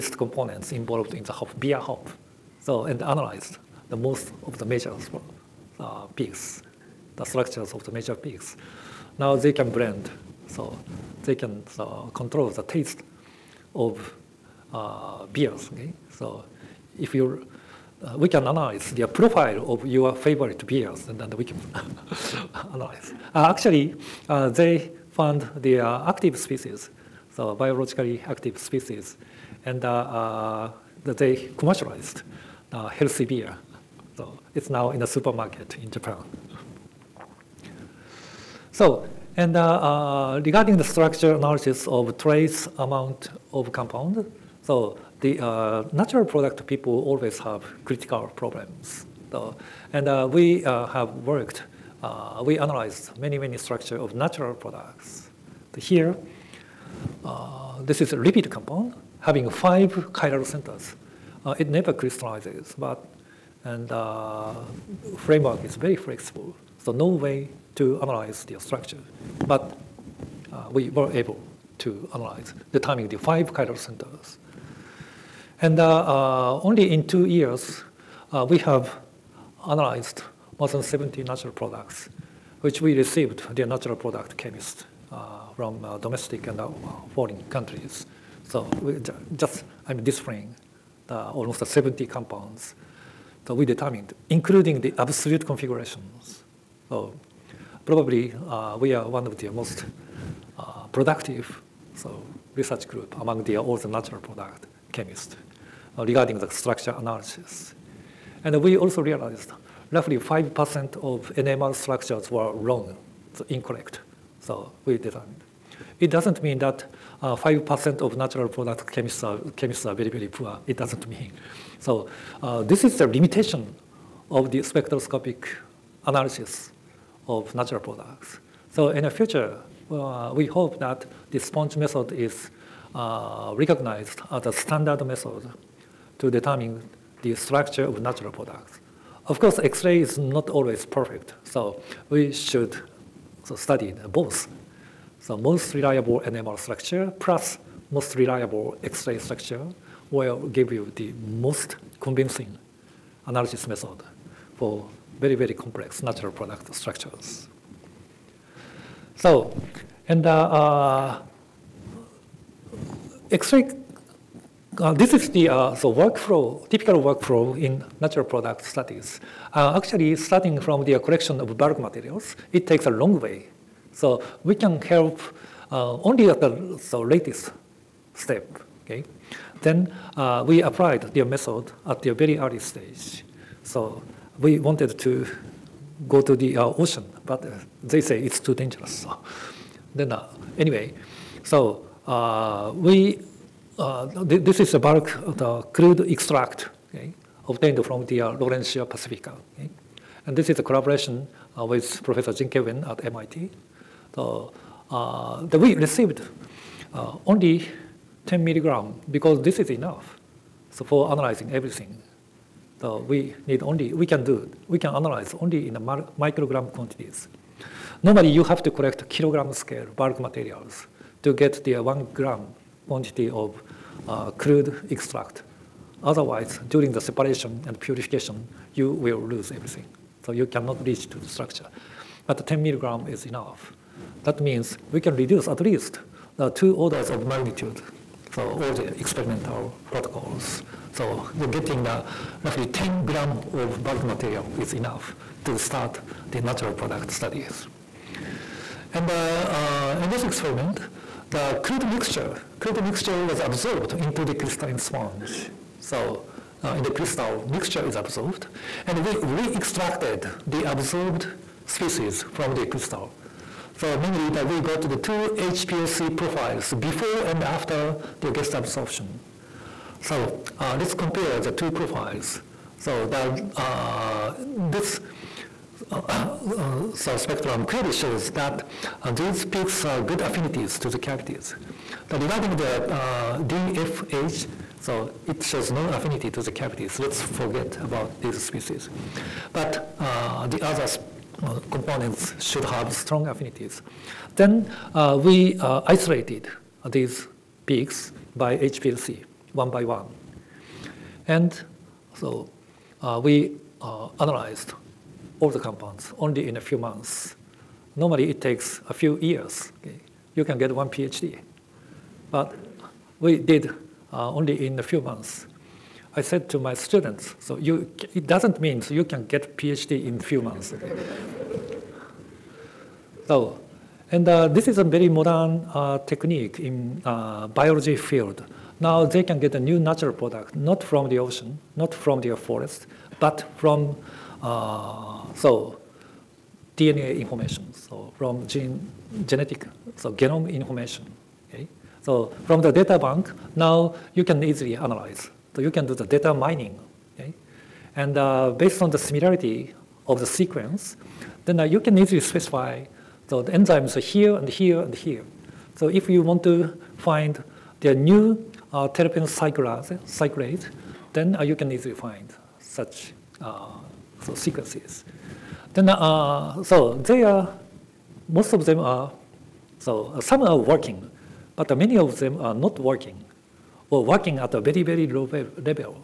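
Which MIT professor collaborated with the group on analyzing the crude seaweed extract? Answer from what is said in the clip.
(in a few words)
Jing-Ke Weng.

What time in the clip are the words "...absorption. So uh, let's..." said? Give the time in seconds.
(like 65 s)
268 s.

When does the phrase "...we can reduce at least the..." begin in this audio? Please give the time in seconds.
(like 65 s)
234 s.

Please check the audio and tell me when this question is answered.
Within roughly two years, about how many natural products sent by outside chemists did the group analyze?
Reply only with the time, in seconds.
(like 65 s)
80 s.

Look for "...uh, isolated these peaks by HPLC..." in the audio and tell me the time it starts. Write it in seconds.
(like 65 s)
295 s.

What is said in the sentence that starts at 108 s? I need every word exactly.
And we also realized roughly 5% of NMR structures were wrong, so incorrect.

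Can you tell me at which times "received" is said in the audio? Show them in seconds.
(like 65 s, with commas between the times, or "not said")
82 s, 205 s.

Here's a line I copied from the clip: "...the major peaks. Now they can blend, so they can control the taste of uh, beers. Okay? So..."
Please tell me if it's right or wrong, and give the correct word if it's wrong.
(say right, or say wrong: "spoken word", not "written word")
right.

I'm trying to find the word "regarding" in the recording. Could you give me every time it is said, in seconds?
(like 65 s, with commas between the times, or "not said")
40 s, 105 s, 282 s.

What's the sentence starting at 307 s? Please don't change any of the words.
Normally it takes a few years.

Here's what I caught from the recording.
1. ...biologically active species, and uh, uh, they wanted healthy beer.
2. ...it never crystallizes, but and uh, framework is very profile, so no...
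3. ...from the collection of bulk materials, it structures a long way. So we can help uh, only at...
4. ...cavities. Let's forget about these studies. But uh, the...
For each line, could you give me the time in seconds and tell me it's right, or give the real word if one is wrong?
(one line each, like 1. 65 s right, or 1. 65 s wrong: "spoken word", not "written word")
1. 27 s wrong: "commercialized", not "wanted"
2. 61 s wrong: "flexible", not "profile"
3. 170 s wrong: "takes", not "structures"
4. 286 s wrong: "species", not "studies".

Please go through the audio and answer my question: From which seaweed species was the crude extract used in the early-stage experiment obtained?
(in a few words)
Laurencia pacifica.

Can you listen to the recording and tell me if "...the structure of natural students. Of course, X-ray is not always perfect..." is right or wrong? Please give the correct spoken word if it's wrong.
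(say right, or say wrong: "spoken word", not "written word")
wrong: "products", not "students".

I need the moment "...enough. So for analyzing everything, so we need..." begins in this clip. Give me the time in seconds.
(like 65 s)
209 s.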